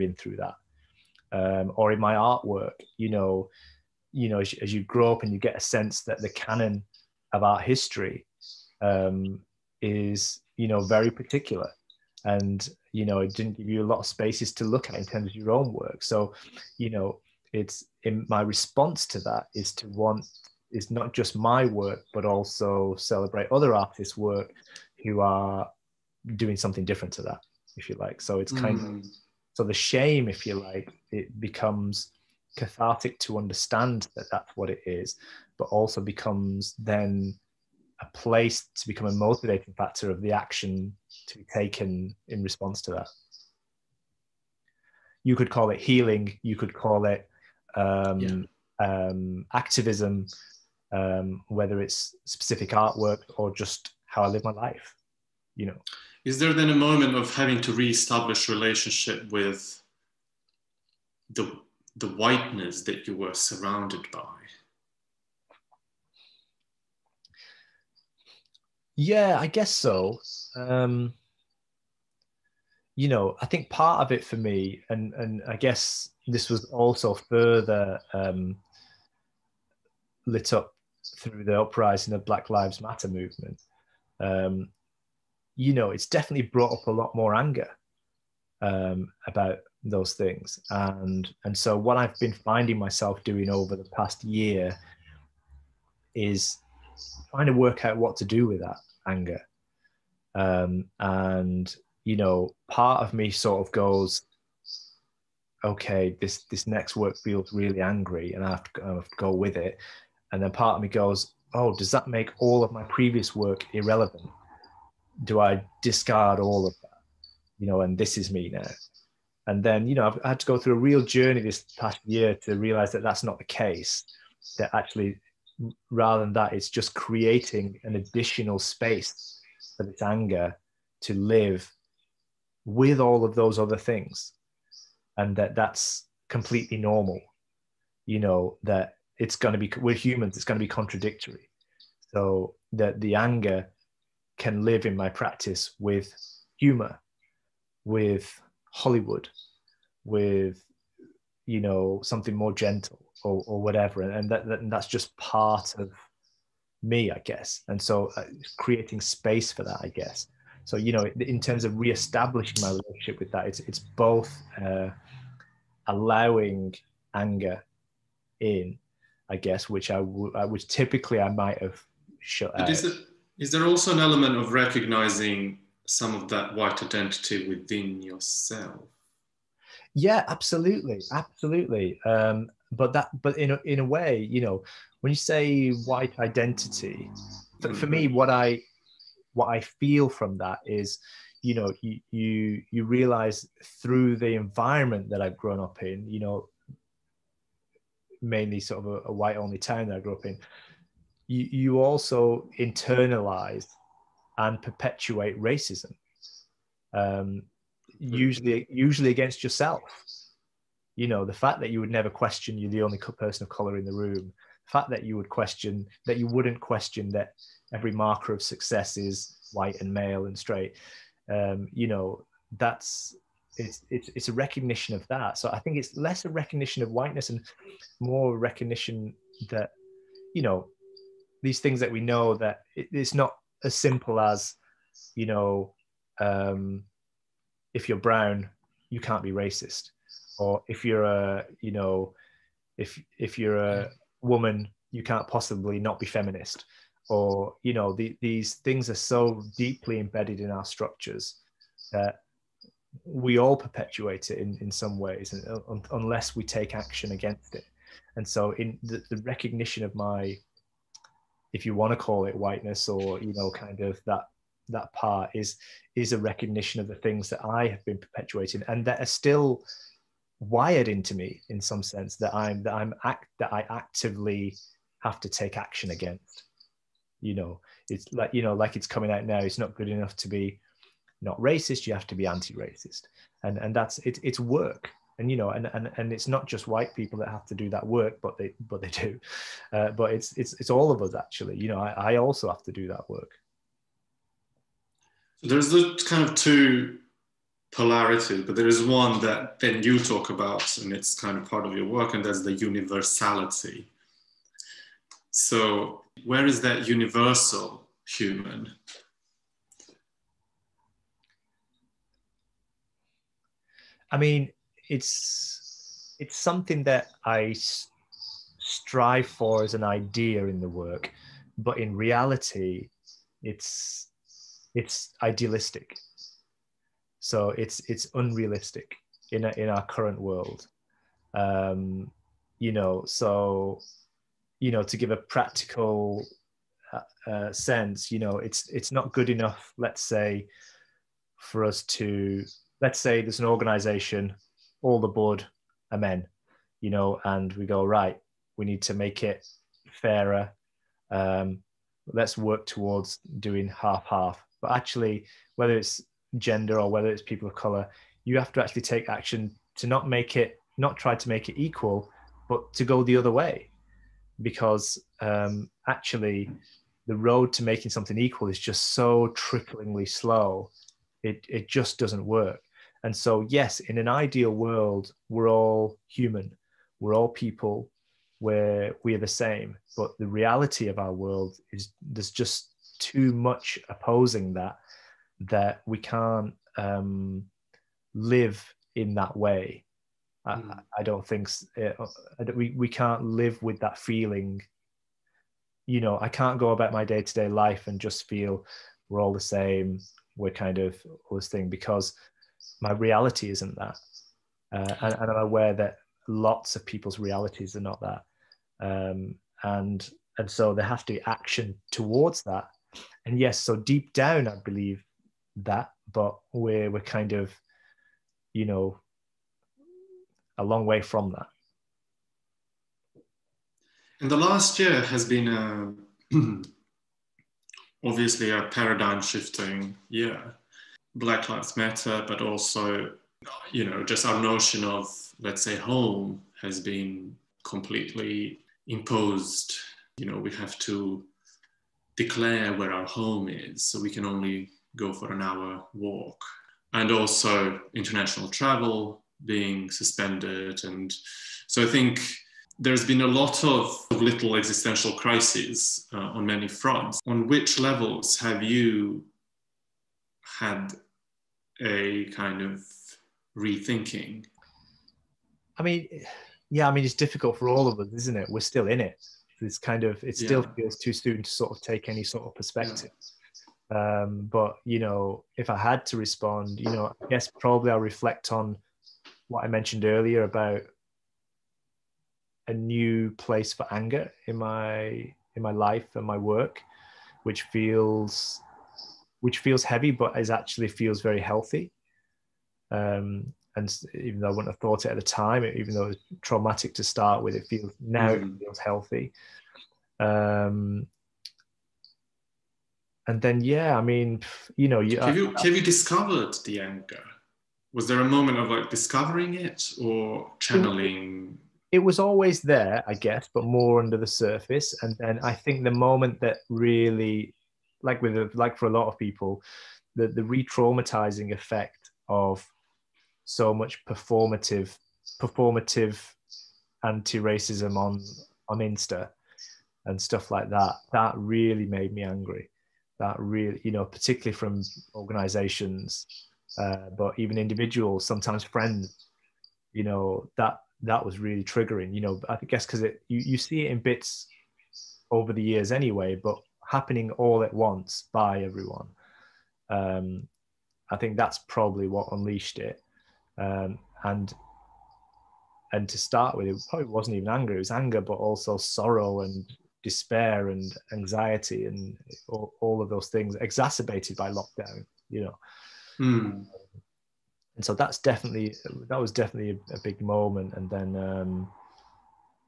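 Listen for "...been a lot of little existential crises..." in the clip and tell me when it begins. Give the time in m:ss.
7:33.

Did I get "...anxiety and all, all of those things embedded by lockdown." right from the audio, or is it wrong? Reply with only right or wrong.
wrong.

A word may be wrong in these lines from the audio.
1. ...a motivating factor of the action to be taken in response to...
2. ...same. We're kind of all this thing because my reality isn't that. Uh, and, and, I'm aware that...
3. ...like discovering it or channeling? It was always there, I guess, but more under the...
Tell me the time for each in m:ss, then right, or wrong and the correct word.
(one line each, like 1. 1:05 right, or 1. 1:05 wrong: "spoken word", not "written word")
1. 0:39 right
2. 6:39 right
3. 8:28 right.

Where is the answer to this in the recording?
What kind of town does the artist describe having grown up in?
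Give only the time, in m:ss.
3:19.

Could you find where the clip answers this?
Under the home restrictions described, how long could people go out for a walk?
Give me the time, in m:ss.
7:25.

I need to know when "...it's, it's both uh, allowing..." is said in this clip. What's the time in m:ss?
2:43.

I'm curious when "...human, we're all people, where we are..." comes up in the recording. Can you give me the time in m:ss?
6:16.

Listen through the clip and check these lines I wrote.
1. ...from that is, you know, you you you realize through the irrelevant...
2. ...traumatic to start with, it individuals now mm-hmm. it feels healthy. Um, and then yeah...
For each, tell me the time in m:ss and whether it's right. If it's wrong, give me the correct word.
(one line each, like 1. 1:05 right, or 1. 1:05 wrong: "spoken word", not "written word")
1. 3:10 wrong: "environment", not "irrelevant"
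2. 8:16 wrong: "feels", not "individuals".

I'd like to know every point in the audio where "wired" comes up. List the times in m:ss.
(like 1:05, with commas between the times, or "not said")
4:30.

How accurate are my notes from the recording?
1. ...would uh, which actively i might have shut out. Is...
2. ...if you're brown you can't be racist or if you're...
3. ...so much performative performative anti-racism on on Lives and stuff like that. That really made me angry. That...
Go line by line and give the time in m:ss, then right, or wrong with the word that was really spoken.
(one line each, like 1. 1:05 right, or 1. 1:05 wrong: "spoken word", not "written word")
1. 2:49 wrong: "typically", not "actively"
2. 3:57 right
3. 8:43 wrong: "Insta", not "Lives".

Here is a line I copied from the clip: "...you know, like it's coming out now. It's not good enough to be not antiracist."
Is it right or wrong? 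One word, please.
wrong.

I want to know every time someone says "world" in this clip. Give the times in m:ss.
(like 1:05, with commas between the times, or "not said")
5:30, 6:14, 6:21.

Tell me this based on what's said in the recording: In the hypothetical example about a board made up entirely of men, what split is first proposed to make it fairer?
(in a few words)
Half half.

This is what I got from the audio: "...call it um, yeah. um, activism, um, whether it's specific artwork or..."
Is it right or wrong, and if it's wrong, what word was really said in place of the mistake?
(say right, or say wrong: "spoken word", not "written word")
right.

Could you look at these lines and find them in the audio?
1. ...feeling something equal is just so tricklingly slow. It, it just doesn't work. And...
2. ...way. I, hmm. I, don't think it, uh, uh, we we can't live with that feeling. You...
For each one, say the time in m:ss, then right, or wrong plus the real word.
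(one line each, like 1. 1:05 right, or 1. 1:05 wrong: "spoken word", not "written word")
1. 6:07 wrong: "making", not "feeling"
2. 6:29 right.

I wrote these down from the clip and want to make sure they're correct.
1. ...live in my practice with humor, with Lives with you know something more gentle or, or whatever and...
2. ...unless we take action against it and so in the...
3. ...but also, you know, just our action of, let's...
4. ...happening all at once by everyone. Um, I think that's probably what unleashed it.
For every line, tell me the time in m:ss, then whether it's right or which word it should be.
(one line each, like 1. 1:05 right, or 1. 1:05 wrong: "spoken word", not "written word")
1. 2:24 wrong: "Hollywood", not "Lives"
2. 4:15 right
3. 7:12 wrong: "notion", not "action"
4. 9:06 right.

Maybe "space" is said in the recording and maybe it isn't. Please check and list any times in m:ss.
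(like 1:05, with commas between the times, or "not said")
0:14, 2:08, 2:39.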